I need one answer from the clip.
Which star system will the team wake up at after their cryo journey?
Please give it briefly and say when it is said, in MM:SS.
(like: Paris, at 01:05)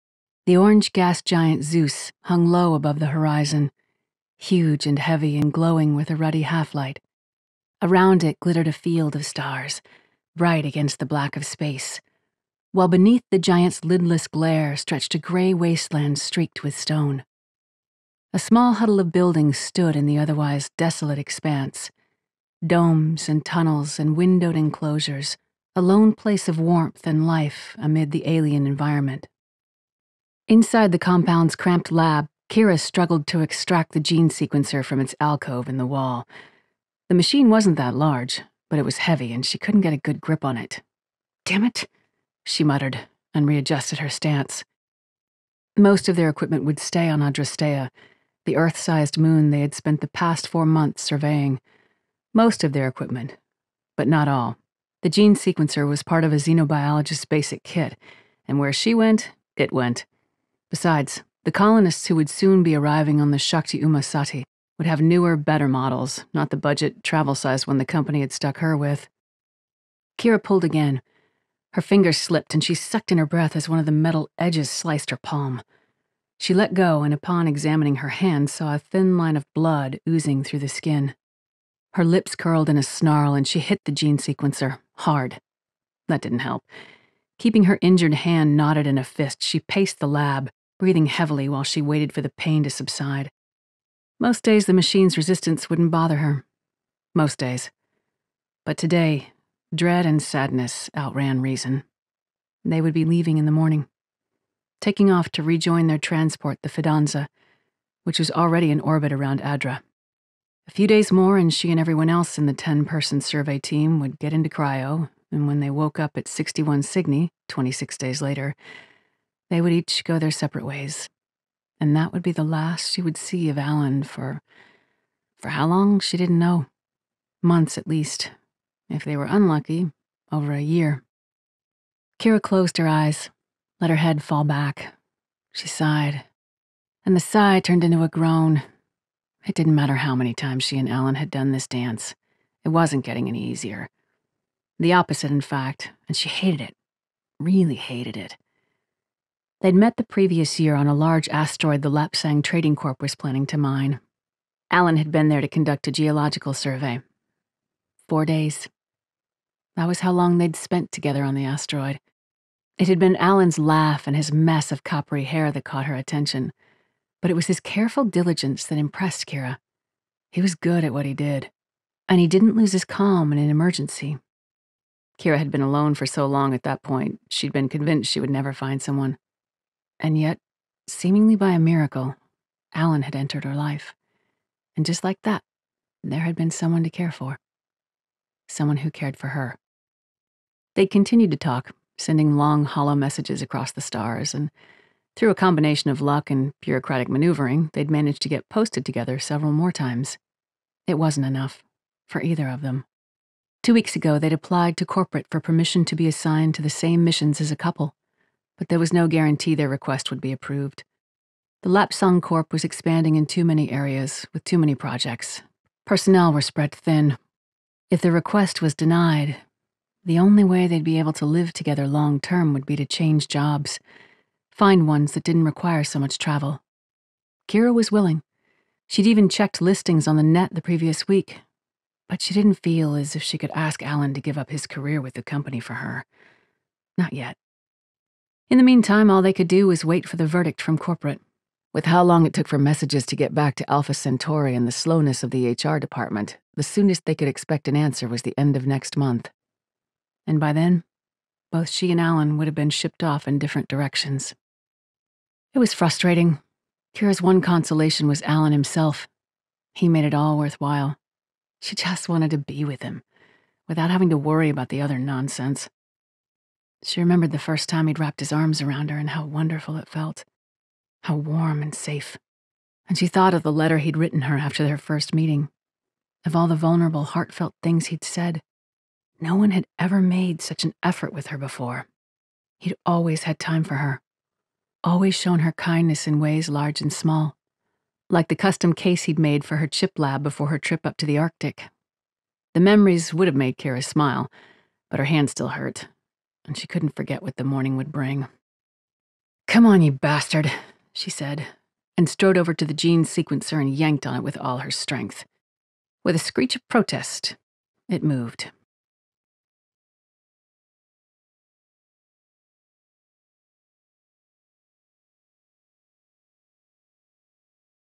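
61 Cygni, at 01:56.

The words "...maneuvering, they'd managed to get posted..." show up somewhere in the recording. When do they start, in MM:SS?
03:17.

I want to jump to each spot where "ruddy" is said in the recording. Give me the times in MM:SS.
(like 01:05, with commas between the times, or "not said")
00:06.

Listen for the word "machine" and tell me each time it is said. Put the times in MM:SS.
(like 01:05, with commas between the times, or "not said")
00:37, 01:34.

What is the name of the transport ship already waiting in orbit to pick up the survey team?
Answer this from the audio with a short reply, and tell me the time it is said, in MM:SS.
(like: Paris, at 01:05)
Fidanza, at 01:46.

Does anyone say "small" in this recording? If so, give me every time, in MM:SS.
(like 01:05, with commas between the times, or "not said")
00:18, 04:46.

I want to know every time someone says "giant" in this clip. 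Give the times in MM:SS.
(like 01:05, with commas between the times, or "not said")
00:01, 00:13.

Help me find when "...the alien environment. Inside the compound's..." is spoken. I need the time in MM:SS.
00:28.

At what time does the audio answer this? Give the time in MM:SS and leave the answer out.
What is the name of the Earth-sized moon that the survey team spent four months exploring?
00:47.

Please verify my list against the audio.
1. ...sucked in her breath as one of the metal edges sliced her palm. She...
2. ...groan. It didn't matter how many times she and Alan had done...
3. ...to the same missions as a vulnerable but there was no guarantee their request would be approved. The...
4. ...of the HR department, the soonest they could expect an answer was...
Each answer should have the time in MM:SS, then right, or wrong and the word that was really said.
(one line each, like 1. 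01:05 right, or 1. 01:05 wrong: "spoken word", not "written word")
1. 01:12 right
2. 02:18 right
3. 03:26 wrong: "couple", not "vulnerable"
4. 04:05 right.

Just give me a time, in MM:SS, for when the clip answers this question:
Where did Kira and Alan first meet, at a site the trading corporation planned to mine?
02:30.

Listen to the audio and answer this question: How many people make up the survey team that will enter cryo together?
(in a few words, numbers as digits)
10.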